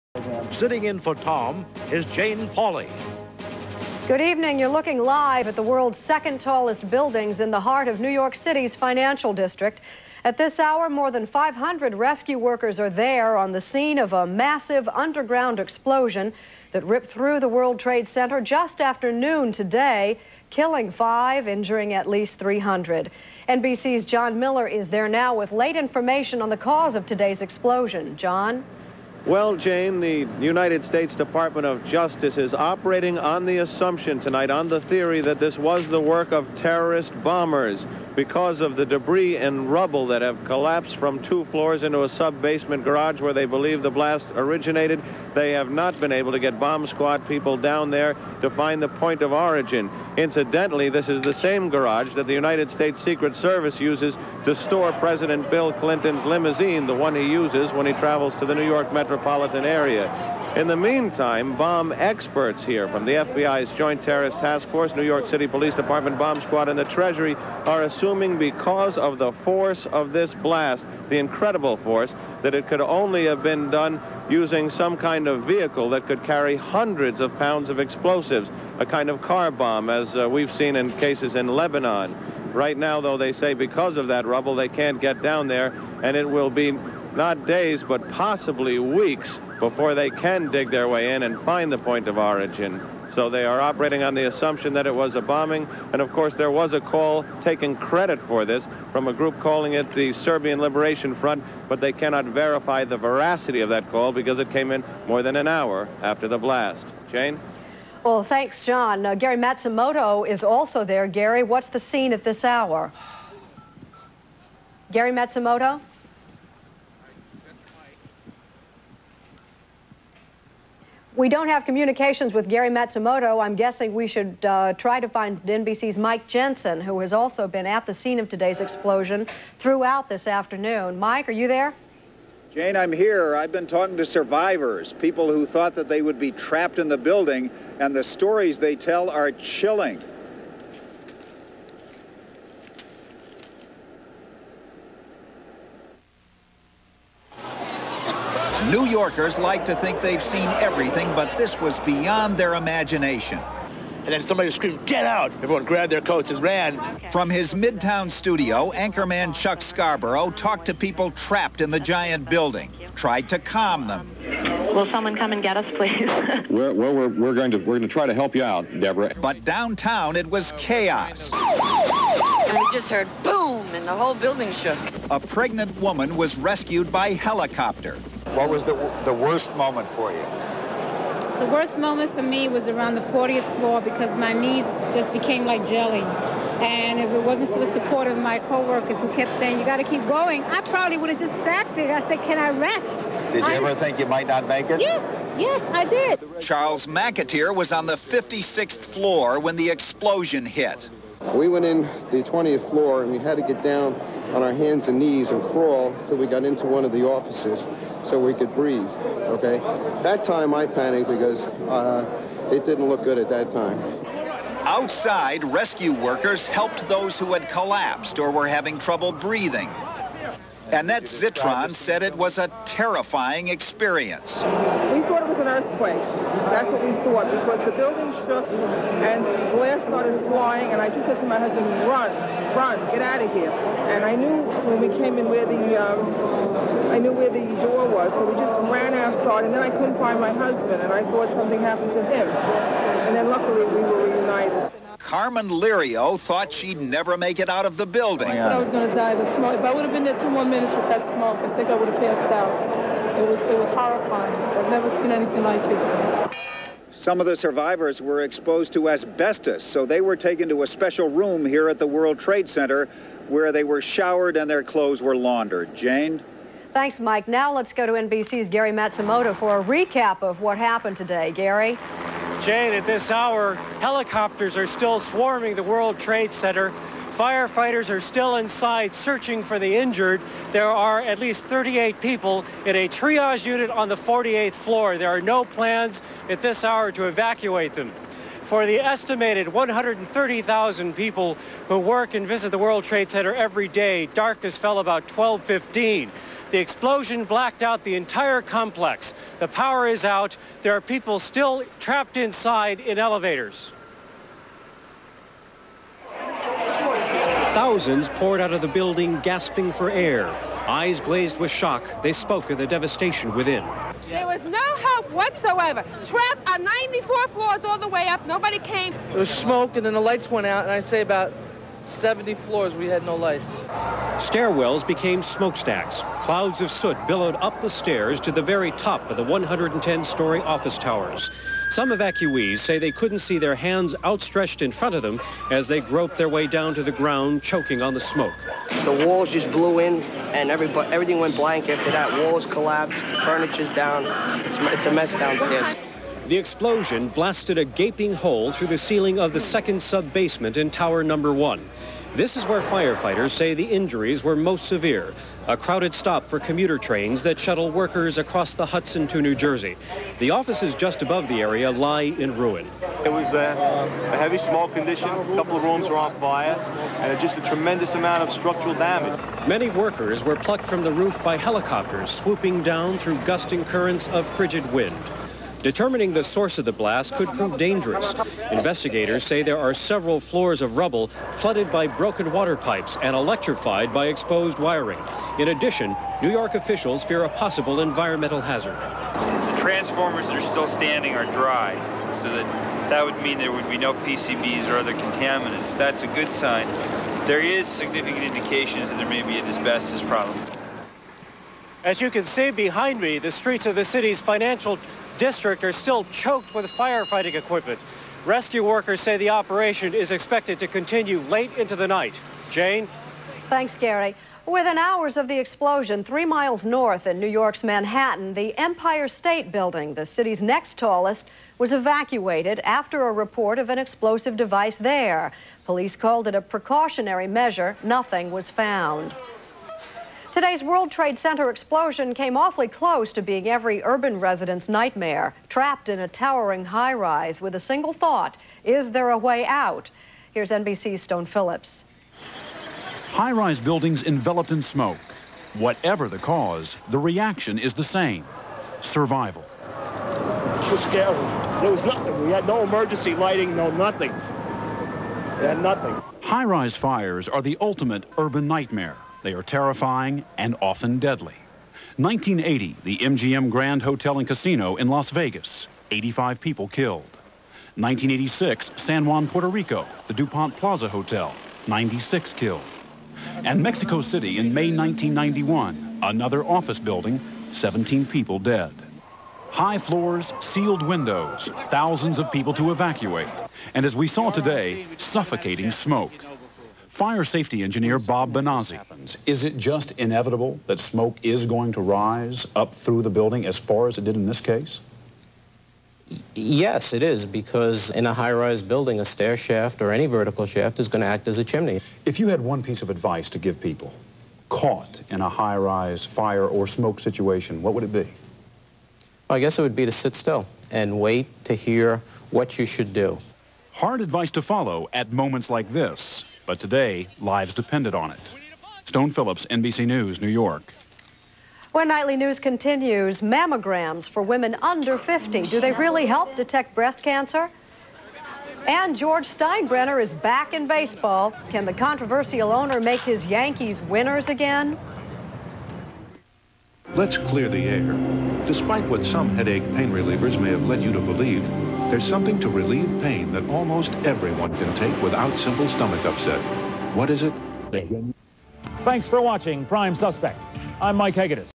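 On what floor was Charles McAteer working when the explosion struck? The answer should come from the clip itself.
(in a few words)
56th floor.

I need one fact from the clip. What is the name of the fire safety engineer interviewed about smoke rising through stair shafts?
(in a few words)
Bob Benazzi.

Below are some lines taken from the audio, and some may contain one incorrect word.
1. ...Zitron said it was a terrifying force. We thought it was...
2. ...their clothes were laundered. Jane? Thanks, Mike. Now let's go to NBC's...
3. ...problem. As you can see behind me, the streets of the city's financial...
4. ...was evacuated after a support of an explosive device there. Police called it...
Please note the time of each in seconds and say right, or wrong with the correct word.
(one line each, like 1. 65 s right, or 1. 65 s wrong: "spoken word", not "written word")
1. 221 s wrong: "experience", not "force"
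2. 264 s right
3. 400 s right
4. 421 s wrong: "report", not "support".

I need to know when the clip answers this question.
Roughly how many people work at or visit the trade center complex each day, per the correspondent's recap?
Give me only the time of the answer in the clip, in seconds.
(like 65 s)
289 s.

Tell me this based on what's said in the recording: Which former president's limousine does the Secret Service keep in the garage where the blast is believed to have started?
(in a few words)
Bill Clinton.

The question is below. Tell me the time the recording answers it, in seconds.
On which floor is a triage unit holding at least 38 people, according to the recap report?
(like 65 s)
283 s.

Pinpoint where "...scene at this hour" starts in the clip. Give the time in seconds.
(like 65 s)
111 s.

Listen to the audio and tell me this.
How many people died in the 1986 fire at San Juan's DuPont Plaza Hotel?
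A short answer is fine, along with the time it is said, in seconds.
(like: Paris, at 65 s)
96, at 471 s.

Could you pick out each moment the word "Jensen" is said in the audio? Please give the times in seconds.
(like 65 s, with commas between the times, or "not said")
126 s.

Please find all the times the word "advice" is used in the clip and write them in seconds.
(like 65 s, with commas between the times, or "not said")
502 s, 514 s.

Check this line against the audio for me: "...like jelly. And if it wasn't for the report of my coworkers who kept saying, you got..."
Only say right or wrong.
wrong.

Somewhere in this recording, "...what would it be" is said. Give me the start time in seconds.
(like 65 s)
507 s.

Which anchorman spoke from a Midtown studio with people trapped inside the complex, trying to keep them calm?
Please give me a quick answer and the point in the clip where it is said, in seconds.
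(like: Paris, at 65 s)
Chuck Scarborough, at 159 s.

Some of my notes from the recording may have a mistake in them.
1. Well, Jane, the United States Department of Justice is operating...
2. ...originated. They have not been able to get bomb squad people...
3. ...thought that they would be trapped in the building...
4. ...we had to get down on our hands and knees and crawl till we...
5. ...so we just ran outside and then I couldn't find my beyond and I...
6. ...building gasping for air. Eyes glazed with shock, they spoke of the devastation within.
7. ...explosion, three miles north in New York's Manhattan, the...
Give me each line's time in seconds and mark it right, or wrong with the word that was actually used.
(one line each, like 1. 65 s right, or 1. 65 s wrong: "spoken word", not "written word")
1. 29 s right
2. 44 s right
3. 135 s right
4. 203 s right
5. 238 s wrong: "husband", not "beyond"
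6. 308 s right
7. 415 s right.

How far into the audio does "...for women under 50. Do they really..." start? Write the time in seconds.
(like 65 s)
524 s.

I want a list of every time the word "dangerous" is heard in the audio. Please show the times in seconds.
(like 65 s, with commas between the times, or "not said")
377 s.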